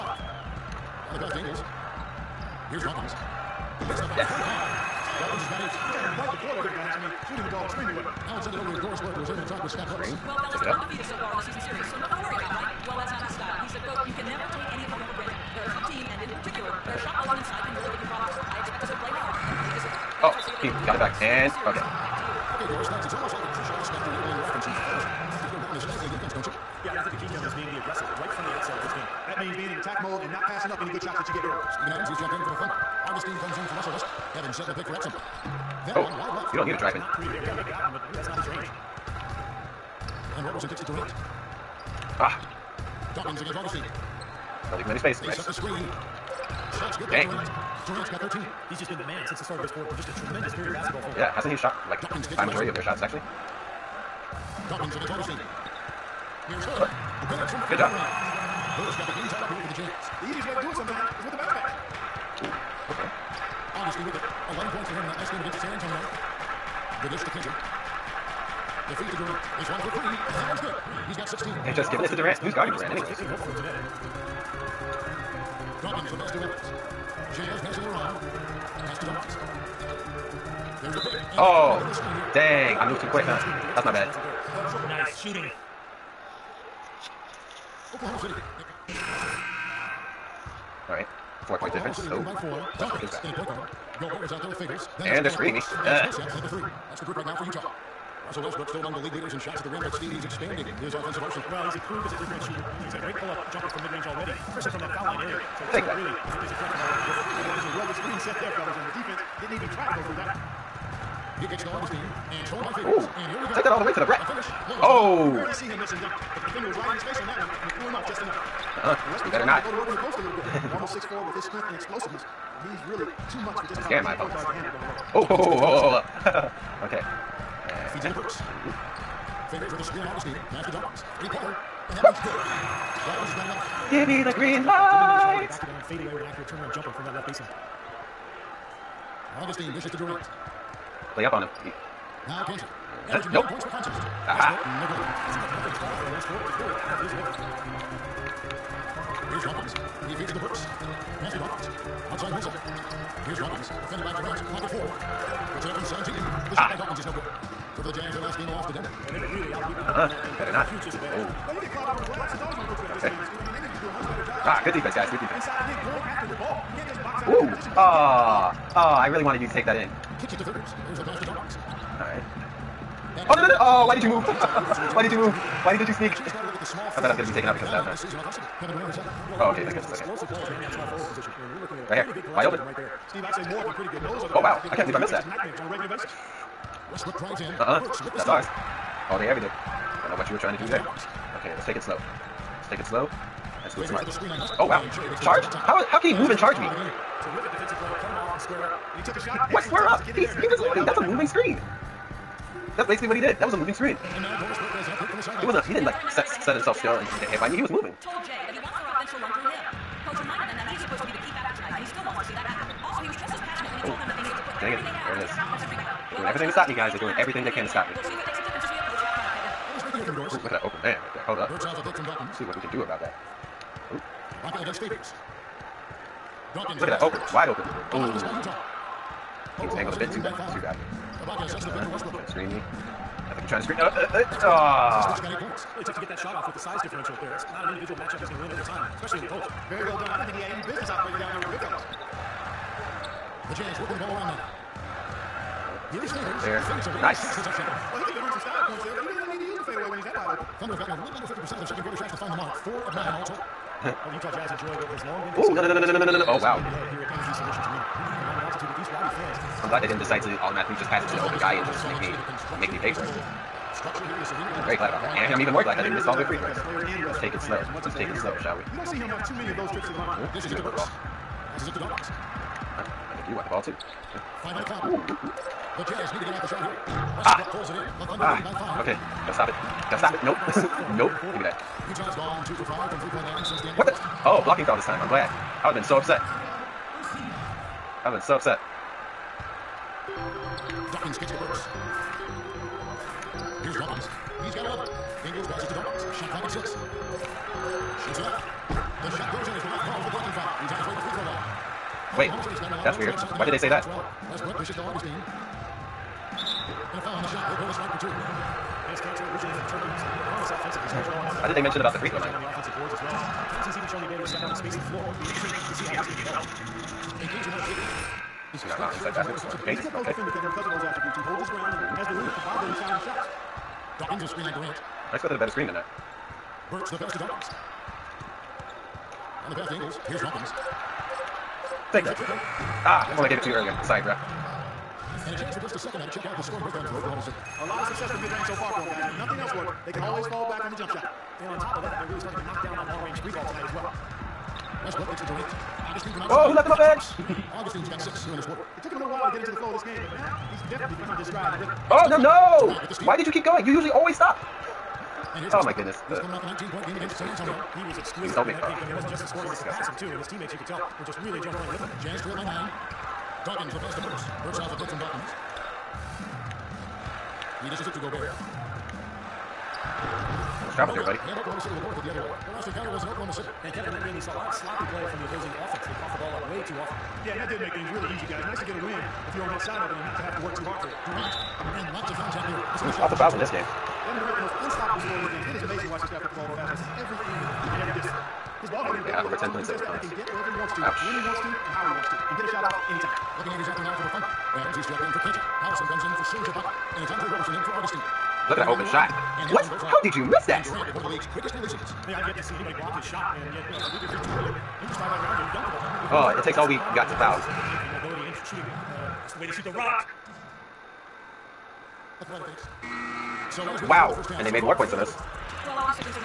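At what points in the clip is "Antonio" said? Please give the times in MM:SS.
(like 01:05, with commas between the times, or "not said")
01:05, 05:57.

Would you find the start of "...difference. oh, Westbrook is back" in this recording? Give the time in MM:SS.
01:31.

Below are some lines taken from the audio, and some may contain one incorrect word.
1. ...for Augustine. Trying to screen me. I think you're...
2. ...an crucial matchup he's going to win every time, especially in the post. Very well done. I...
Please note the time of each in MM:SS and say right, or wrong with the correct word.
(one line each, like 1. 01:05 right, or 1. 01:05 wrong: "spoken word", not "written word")
1. 03:51 wrong: "Westbrook", not "Augustine"
2. 03:57 wrong: "individual", not "crucial".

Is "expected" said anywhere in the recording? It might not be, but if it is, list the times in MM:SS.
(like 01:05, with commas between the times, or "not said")
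05:25.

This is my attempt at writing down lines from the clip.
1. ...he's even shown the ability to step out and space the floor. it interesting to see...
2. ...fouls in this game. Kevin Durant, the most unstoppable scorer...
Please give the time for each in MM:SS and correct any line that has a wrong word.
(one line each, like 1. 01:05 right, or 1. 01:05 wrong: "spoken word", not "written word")
1. 05:13 right
2. 06:23 right.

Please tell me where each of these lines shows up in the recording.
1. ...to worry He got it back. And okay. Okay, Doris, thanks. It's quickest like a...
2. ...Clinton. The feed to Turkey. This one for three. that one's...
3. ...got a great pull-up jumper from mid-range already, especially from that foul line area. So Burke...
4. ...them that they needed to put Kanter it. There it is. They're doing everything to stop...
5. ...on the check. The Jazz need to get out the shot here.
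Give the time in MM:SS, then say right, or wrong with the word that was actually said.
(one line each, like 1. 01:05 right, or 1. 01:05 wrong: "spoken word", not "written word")
1. 00:12 wrong: "almost", not "quickest"
2. 01:07 wrong: "Durant", not "Turkey"
3. 01:42 wrong: "Take", not "Burke"
4. 03:34 wrong: "Dang", not "Kanter"
5. 04:34 wrong: "clock", not "check".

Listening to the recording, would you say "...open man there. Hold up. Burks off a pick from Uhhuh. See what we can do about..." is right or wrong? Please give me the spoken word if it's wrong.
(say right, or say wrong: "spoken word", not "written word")
wrong: "Dawkins", not "Uhhuh".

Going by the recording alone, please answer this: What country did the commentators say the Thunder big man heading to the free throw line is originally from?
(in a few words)
Turkey.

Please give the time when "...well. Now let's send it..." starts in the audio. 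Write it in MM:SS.
00:07.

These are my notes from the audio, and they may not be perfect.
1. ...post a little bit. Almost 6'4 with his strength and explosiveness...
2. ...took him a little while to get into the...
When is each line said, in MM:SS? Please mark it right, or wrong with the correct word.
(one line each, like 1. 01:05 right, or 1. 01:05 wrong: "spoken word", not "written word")
1. 02:00 right
2. 05:48 right.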